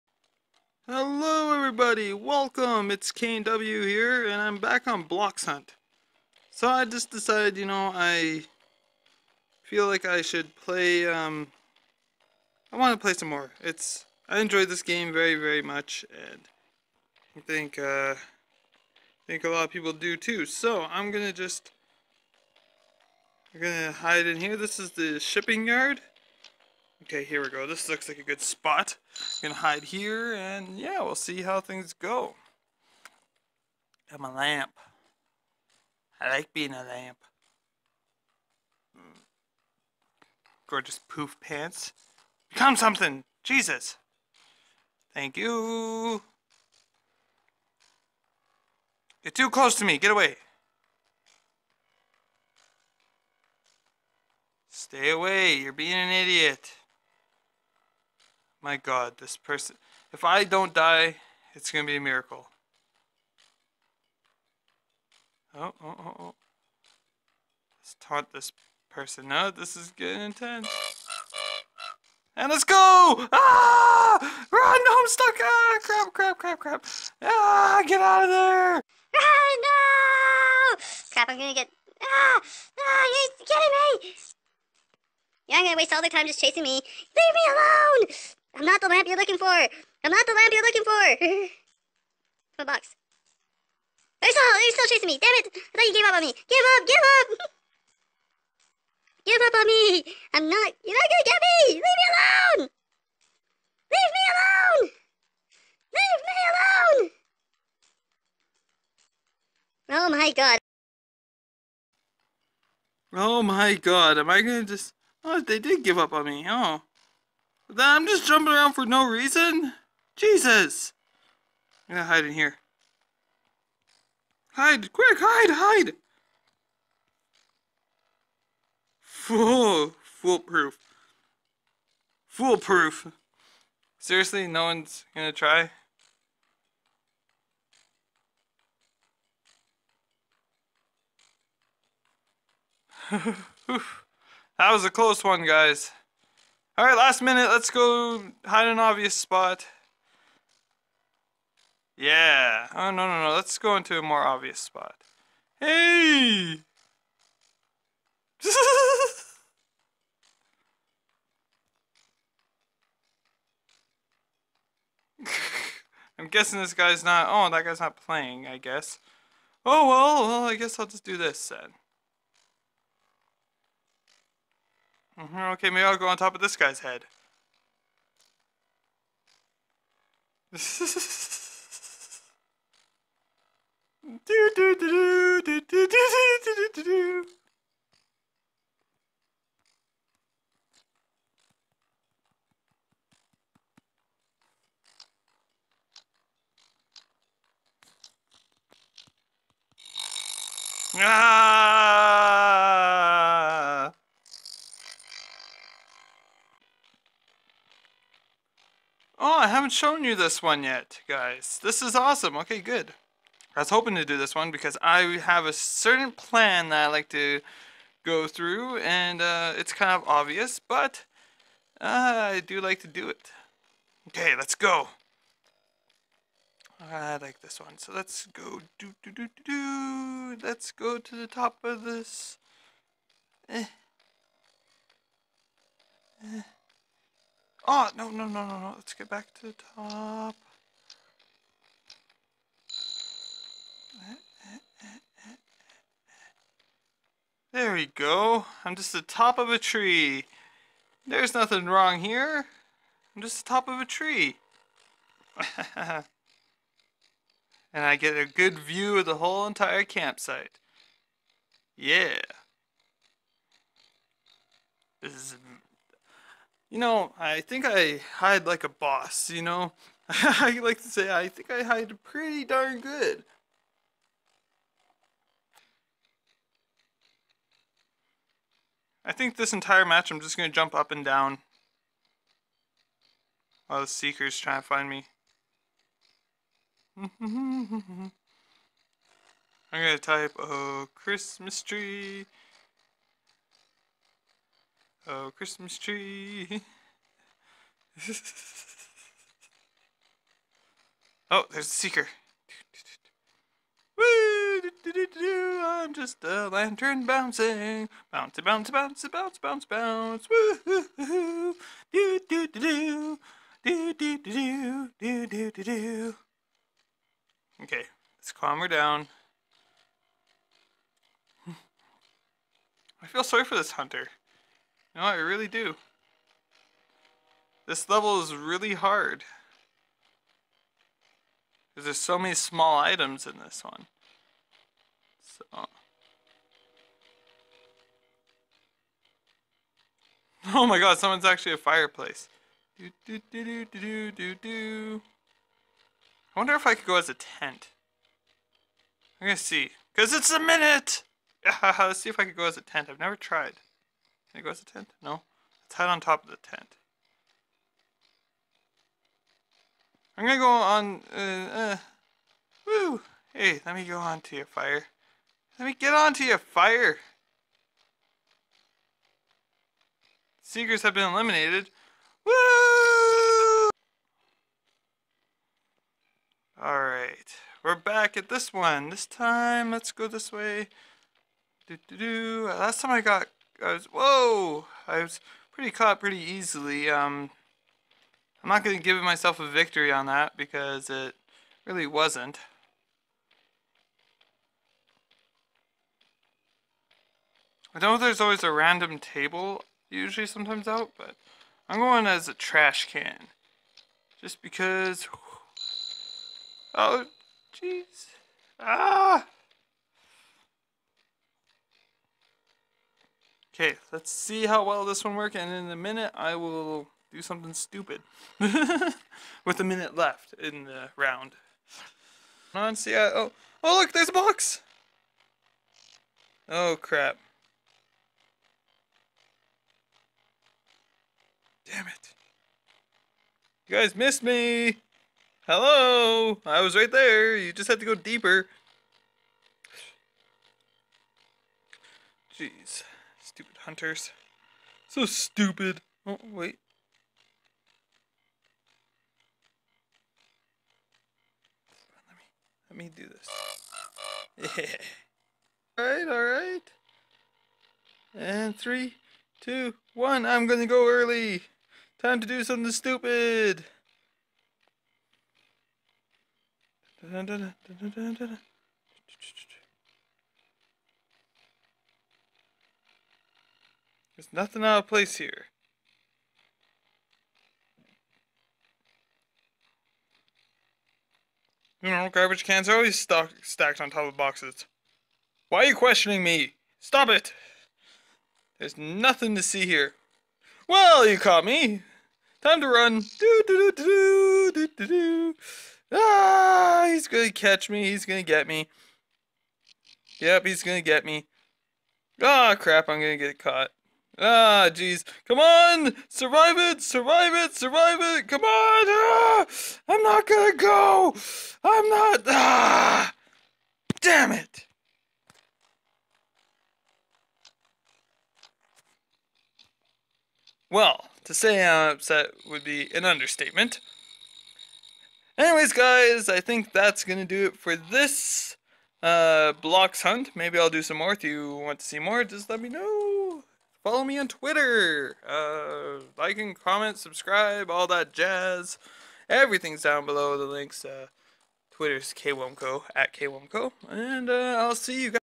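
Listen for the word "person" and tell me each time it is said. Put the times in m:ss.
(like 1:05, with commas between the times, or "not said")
0:59, 1:08.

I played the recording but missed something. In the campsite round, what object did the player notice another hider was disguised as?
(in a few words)
A fireplace.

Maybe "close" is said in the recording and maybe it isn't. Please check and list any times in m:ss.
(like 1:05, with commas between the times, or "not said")
0:49, 2:24.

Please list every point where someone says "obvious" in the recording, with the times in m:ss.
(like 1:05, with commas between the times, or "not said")
2:28, 2:34, 3:40.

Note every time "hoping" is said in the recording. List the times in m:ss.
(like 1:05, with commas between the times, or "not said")
3:33.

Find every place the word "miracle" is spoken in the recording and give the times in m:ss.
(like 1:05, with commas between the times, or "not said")
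1:02.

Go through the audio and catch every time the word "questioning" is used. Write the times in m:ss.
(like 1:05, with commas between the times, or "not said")
8:05.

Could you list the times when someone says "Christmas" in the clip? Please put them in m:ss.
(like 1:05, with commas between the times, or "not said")
4:50, 4:55.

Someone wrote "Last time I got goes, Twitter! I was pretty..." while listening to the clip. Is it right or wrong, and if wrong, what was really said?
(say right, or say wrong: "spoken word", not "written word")
wrong: "Whoa", not "Twitter".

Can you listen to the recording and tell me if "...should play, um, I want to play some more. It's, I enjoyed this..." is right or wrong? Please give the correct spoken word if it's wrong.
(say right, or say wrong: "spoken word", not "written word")
right.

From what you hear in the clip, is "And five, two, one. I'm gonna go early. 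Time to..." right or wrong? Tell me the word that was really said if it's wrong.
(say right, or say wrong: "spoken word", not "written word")
wrong: "three", not "five".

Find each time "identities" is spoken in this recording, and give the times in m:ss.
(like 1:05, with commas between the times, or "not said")
not said.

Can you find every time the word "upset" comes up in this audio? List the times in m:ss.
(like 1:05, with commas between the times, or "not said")
8:41.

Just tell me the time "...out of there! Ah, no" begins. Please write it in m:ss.
1:17.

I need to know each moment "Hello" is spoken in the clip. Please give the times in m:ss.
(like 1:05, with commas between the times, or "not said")
0:00, 7:15.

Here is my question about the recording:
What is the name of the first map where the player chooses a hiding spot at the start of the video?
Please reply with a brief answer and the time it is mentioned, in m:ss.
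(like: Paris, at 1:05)
Shipping yard, at 0:25.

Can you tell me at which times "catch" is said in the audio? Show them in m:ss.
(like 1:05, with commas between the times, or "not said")
8:17.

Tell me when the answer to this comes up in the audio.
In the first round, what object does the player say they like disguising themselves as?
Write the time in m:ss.
0:36.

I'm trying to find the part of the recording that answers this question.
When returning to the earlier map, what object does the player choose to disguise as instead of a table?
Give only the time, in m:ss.
6:42.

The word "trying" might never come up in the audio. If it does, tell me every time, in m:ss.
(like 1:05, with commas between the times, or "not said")
4:44.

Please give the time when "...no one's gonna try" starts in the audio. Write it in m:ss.
2:14.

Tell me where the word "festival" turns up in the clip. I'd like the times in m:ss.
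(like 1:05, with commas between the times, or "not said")
not said.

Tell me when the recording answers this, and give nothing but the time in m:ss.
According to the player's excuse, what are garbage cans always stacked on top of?
8:04.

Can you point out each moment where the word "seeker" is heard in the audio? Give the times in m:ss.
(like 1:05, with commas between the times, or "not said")
4:43, 5:01, 6:10.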